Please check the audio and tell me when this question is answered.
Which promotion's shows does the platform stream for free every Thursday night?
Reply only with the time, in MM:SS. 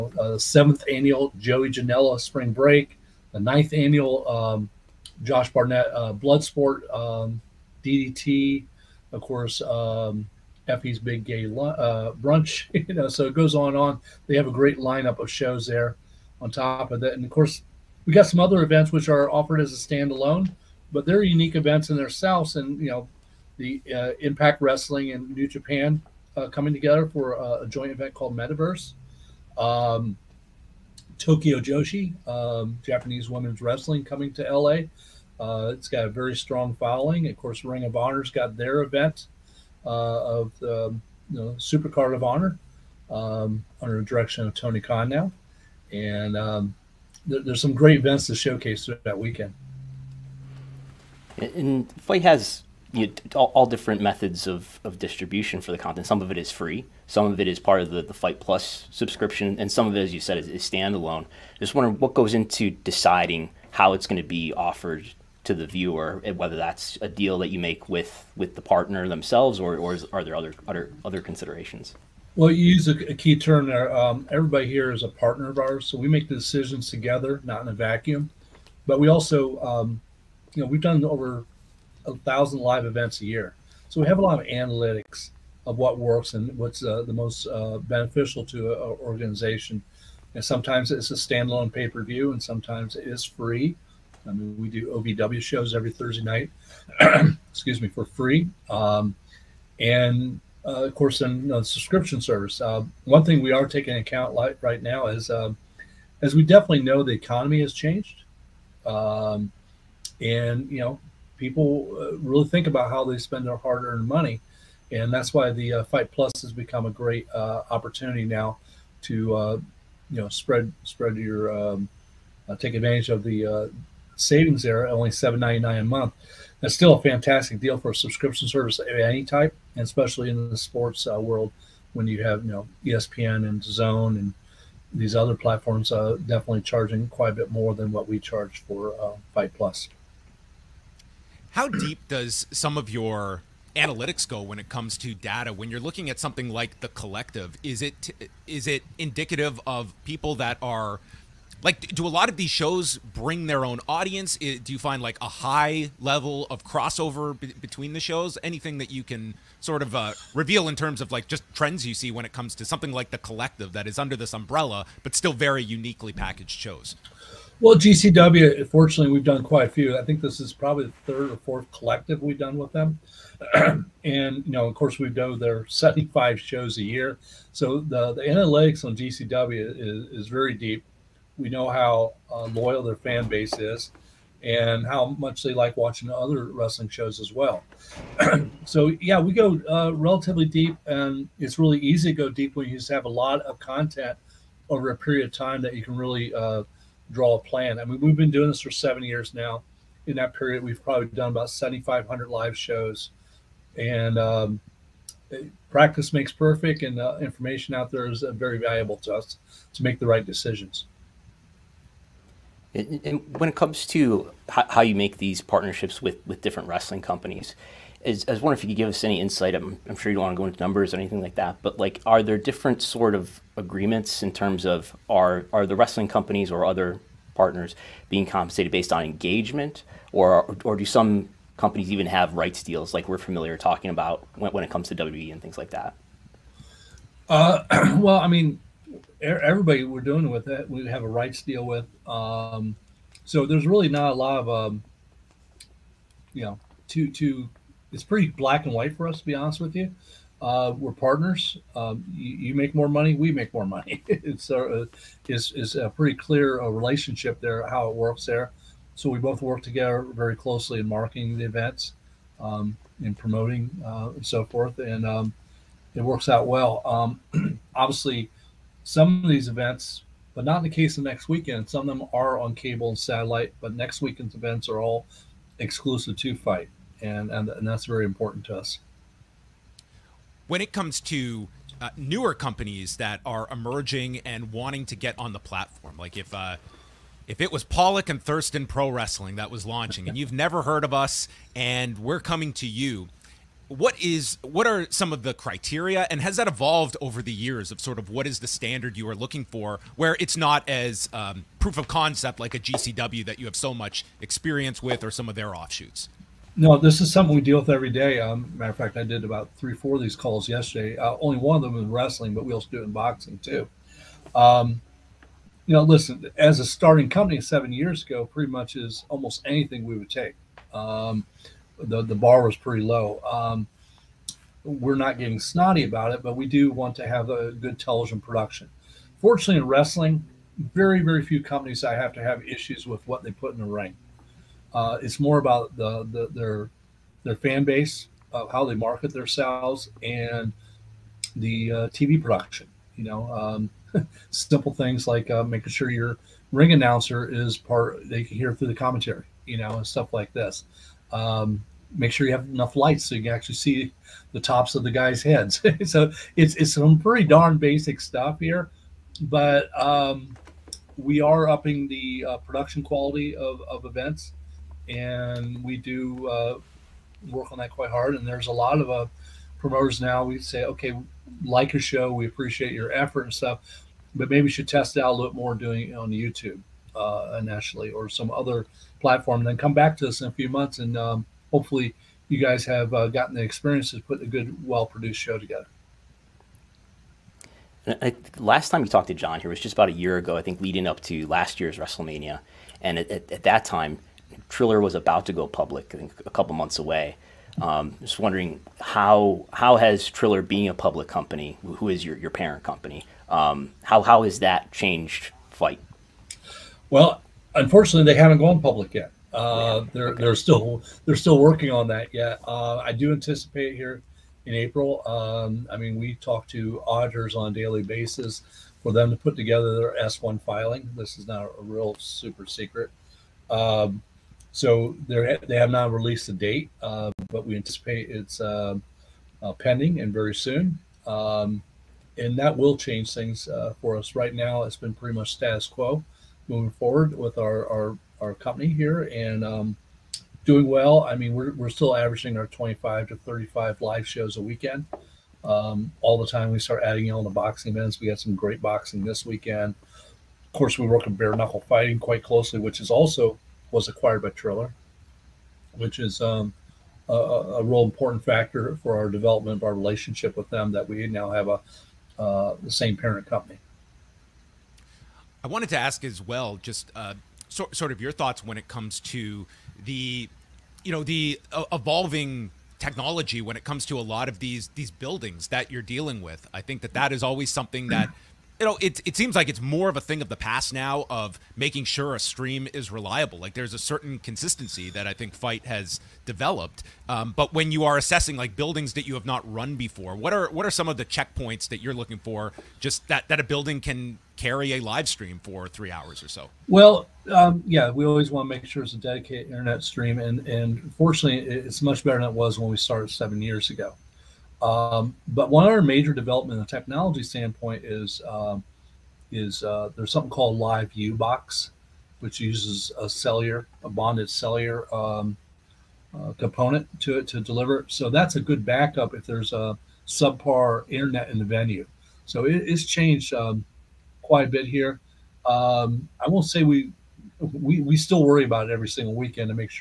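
01:34.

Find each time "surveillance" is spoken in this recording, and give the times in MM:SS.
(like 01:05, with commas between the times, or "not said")
not said.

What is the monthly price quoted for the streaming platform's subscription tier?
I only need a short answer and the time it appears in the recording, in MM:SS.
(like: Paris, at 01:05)
$7.99, at 02:05.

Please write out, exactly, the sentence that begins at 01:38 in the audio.
Um, and uh, of course, in the uh, subscription service.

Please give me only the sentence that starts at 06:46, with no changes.
Well, unfortunately, they haven't gone public yet.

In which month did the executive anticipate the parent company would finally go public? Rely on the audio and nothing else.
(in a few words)
April.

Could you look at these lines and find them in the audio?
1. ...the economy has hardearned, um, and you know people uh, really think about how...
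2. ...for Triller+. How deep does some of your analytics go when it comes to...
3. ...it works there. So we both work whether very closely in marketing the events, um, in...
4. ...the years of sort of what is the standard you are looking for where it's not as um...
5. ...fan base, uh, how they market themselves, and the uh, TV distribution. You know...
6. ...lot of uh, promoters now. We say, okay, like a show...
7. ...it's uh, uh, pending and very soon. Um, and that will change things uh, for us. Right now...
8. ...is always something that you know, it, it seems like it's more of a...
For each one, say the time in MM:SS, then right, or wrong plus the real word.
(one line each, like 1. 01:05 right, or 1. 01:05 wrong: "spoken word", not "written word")
1. 01:47 wrong: "changed", not "hardearned"
2. 02:18 wrong: "FITE", not "Triller"
3. 04:17 wrong: "together", not "whether"
4. 04:57 right
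5. 05:37 wrong: "production", not "distribution"
6. 06:08 right
7. 07:08 right
8. 07:57 right.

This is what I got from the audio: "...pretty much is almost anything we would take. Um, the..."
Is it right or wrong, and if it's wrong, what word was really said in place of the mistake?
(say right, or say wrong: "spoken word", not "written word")
right.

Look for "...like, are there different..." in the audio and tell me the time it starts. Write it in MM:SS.
03:41.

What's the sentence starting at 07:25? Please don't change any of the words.
Um, all the time we start adding on the boxing events.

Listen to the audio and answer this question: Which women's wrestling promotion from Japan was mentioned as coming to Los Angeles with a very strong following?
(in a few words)
Tokyo Joshi.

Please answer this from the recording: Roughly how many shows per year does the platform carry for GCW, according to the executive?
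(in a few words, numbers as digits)
75.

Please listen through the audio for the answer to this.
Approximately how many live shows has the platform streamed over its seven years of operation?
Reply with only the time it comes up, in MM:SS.
03:21.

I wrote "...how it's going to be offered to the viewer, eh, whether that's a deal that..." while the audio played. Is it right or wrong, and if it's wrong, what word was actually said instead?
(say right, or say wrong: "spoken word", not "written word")
right.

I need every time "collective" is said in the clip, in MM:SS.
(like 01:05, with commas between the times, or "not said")
02:26, 02:43, 02:51.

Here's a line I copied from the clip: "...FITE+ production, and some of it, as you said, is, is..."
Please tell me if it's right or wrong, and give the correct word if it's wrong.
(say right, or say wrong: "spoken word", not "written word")
wrong: "subscription", not "production".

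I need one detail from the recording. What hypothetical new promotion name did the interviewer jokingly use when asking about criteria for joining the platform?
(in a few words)
Pollock and Thurston Pro Wrestling.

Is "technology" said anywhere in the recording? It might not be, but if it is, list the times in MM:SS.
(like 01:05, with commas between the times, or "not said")
07:52, 08:26.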